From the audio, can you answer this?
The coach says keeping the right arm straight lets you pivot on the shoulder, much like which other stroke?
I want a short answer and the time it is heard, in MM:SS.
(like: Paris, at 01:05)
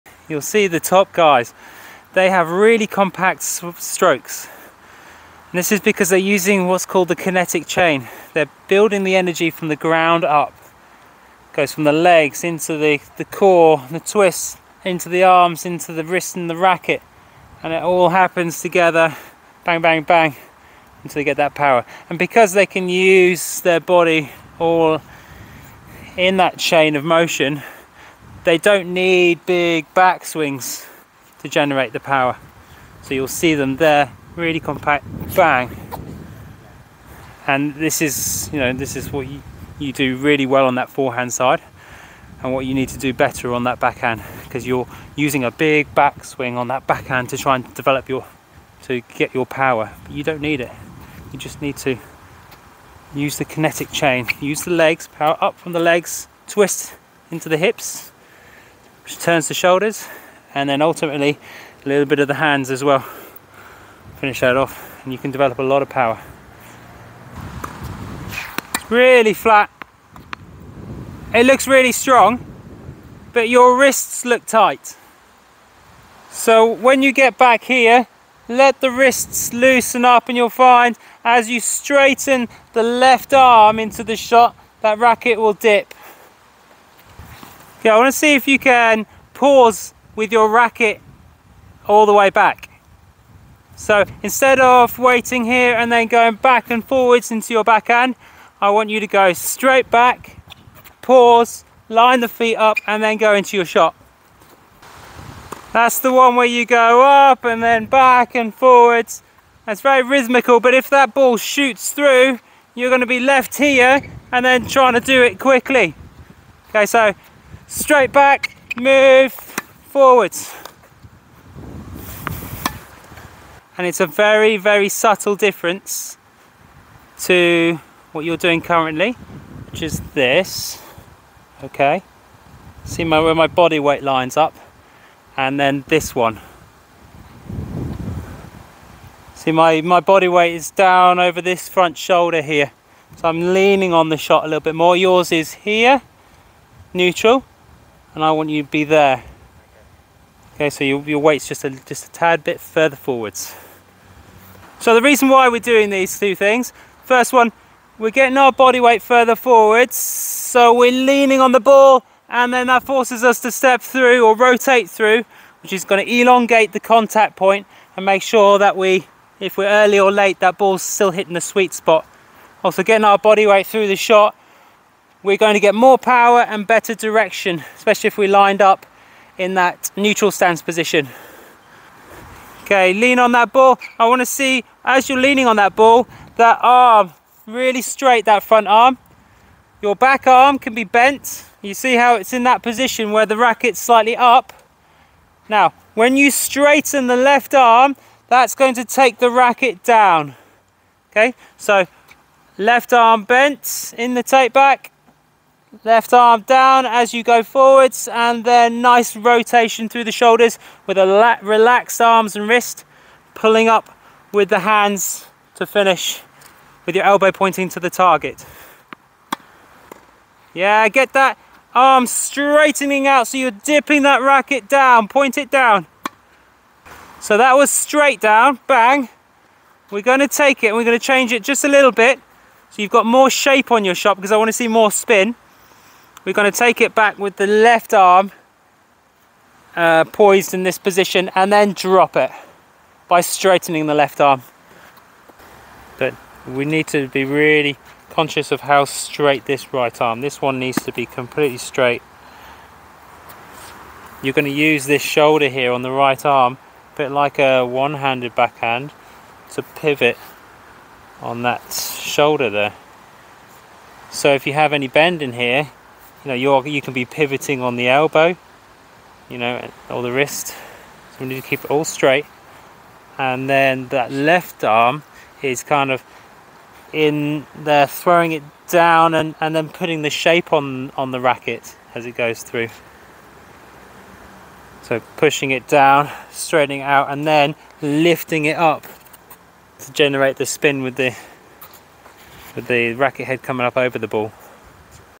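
one-handed backhand, at 04:17.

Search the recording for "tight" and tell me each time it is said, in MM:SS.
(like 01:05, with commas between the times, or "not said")
01:14.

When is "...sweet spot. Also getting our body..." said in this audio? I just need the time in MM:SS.
02:51.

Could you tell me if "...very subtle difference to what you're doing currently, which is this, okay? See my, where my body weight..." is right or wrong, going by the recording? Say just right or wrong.
right.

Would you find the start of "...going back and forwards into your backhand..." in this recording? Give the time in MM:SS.
01:36.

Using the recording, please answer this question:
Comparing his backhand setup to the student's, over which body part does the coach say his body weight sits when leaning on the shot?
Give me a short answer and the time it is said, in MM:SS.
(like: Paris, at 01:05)
front shoulder, at 02:21.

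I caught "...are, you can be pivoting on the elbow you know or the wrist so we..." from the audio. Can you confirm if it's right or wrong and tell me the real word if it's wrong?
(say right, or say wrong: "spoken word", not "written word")
right.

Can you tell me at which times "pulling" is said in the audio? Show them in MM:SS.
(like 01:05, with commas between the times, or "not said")
03:33.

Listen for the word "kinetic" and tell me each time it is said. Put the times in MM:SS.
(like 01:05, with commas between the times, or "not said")
00:07, 00:53.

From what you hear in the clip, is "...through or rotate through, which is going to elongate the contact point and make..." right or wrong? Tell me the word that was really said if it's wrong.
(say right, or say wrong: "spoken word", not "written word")
right.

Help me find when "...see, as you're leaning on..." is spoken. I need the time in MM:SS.
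03:04.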